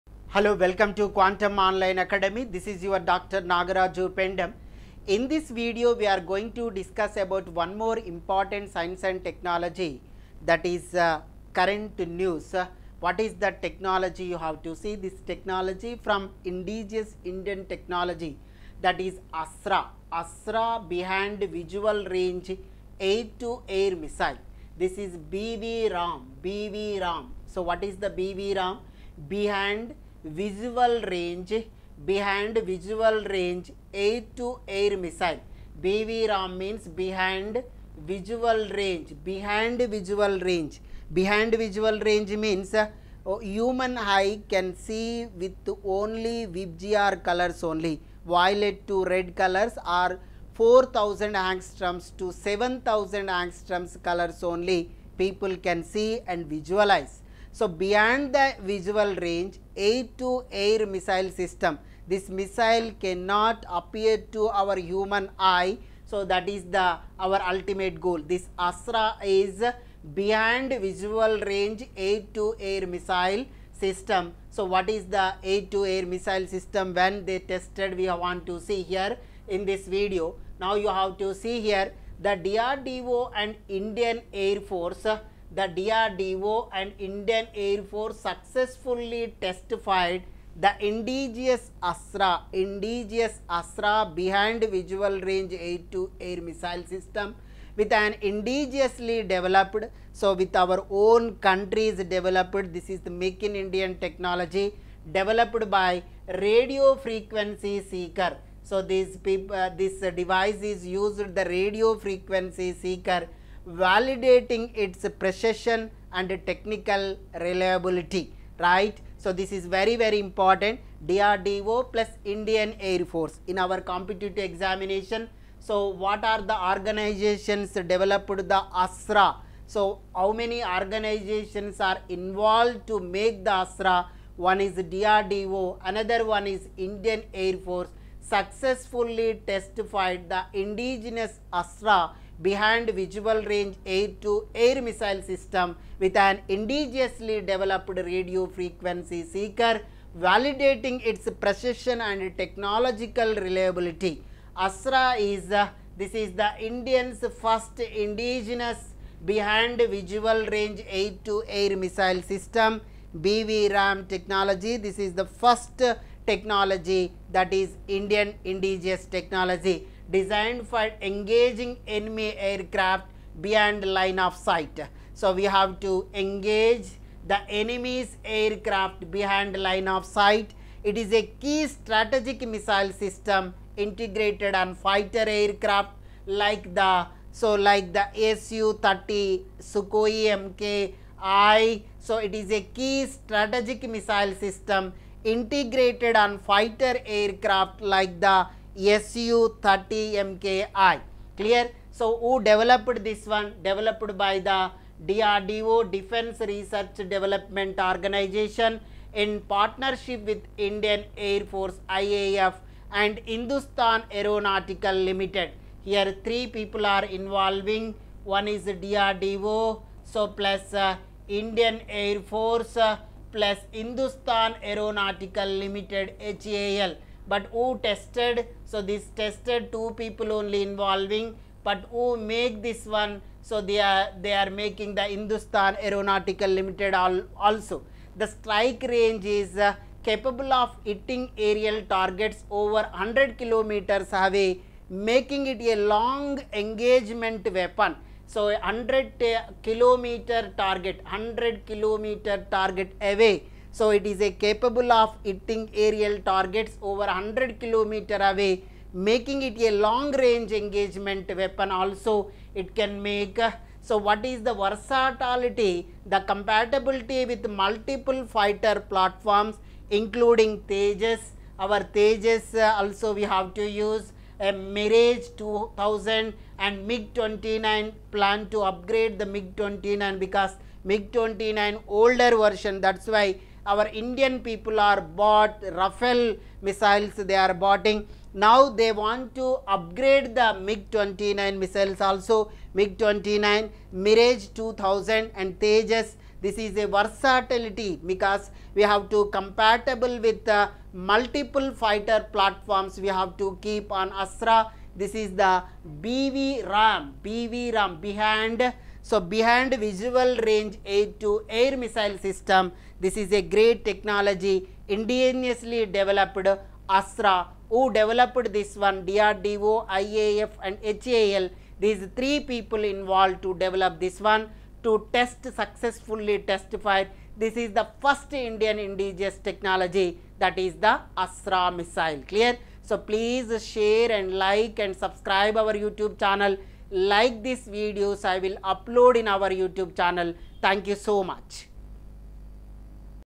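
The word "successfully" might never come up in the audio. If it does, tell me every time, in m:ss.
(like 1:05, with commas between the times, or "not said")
1:28, 2:18, 5:25.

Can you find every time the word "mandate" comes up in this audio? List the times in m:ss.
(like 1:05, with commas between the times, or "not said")
not said.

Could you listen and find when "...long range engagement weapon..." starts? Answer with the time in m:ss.
4:19.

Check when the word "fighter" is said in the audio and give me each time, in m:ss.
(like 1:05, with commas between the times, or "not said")
3:04, 3:16, 4:28, 5:01.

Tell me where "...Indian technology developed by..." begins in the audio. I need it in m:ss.
1:43.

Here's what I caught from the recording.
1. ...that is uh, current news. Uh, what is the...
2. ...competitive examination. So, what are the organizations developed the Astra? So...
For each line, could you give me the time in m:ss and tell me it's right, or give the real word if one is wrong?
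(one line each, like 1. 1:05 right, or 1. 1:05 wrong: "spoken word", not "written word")
1. 0:10 right
2. 2:03 right.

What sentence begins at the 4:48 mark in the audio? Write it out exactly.
Now they want to upgrade the MiG-29 missiles also, MiG-29, Mirage 2000 and Tejas.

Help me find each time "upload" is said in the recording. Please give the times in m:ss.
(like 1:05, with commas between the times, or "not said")
5:38.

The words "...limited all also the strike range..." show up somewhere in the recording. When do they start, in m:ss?
3:56.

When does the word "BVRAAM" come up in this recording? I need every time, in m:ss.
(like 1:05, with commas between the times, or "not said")
0:35, 2:43.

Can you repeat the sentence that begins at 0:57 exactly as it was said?
So, beyond the visual range air to air missile system, this missile cannot appear to our human eye.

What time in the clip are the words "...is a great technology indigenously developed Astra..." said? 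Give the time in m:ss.
5:13.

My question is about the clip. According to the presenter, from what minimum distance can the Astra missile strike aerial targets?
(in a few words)
100 kilometers.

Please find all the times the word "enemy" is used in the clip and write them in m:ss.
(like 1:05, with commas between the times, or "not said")
2:51, 2:57.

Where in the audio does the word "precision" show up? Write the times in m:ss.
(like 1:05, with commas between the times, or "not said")
1:55, 2:31.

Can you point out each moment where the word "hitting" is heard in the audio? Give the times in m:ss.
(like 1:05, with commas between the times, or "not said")
4:00, 4:15.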